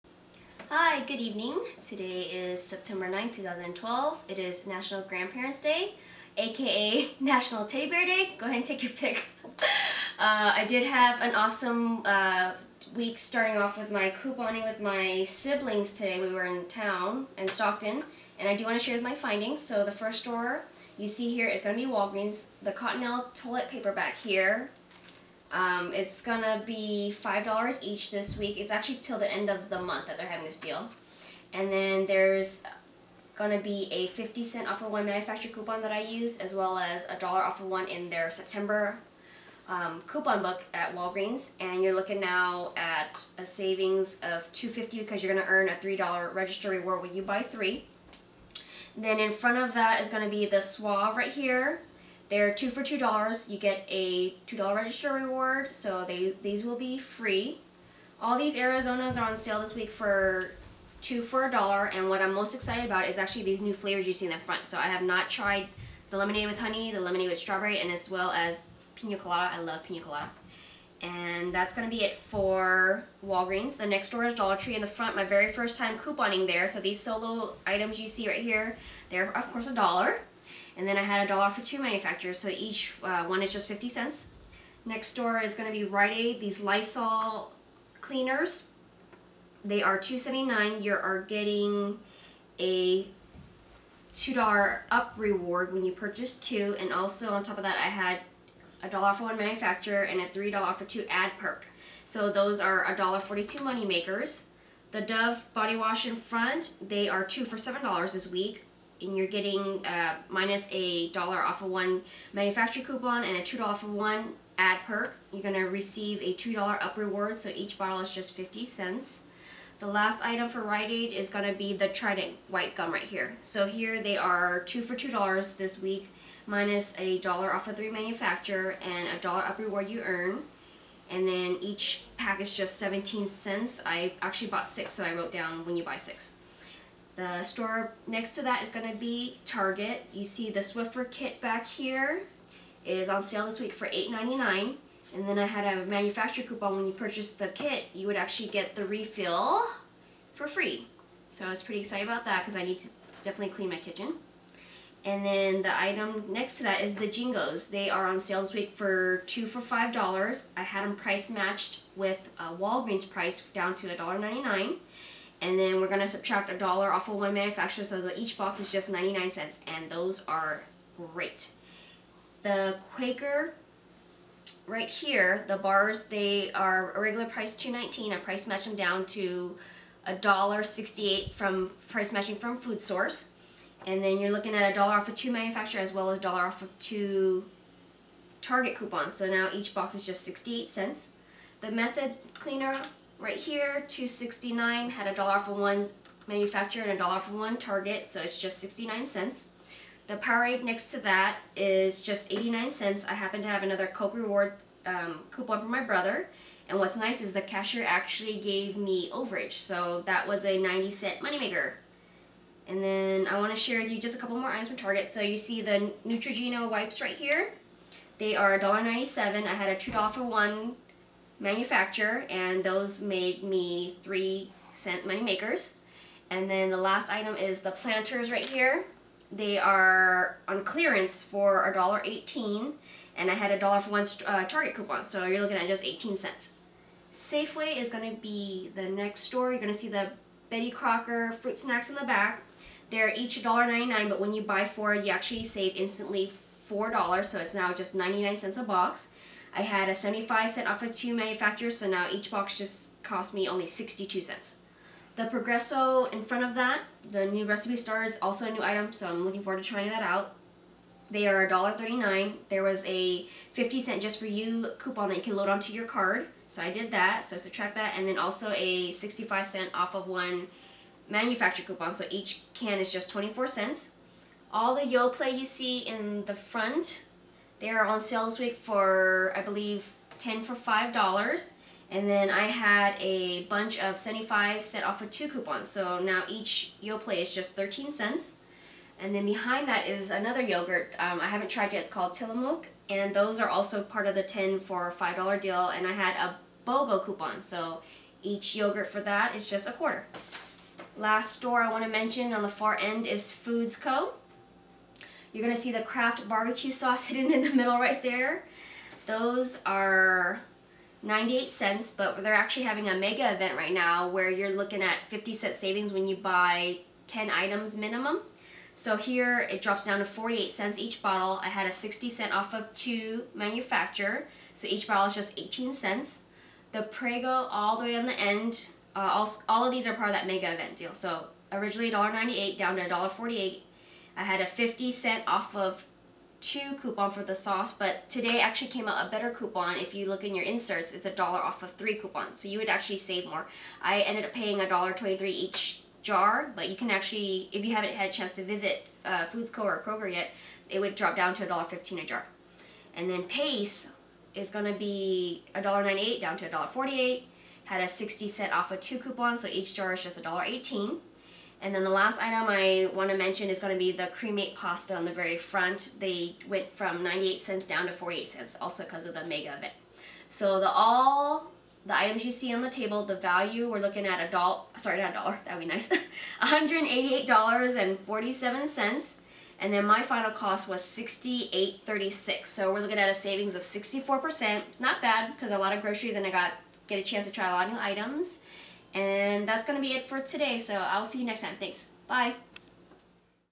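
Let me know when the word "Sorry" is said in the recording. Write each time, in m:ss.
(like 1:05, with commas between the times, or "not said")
6:14.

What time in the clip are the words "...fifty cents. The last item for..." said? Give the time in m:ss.
1:58.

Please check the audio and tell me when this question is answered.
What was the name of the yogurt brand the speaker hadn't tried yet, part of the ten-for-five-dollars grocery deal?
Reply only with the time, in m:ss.
4:52.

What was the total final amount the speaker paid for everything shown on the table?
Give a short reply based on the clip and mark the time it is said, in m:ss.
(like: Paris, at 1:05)
$68.36, at 6:20.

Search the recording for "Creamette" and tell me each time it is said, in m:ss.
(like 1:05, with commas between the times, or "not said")
6:04.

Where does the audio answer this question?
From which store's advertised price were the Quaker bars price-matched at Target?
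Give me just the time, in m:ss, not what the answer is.
3:02.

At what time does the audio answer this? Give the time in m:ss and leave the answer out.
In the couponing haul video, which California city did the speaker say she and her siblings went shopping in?
0:17.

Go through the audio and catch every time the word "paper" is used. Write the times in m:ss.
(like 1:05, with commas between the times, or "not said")
0:23.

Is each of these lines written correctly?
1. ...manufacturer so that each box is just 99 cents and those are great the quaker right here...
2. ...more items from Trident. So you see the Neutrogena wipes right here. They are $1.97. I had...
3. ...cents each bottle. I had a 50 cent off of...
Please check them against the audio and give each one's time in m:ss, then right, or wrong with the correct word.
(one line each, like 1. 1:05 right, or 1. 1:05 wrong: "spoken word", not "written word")
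1. 2:47 right
2. 3:34 wrong: "Target", not "Trident"
3. 5:20 wrong: "60", not "50".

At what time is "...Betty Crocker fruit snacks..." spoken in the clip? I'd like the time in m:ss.
4:00.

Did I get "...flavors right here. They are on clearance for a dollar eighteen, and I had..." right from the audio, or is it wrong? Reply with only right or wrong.
wrong.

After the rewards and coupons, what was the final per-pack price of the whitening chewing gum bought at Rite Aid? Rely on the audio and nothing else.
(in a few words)
17 cents.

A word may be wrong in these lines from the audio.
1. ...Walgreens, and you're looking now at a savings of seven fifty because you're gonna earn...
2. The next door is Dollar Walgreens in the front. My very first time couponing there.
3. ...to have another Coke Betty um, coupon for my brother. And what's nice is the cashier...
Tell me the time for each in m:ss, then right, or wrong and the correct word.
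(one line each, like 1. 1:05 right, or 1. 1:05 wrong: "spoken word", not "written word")
1. 0:40 wrong: "two", not "seven"
2. 1:13 wrong: "Tree", not "Walgreens"
3. 3:23 wrong: "Reward", not "Betty".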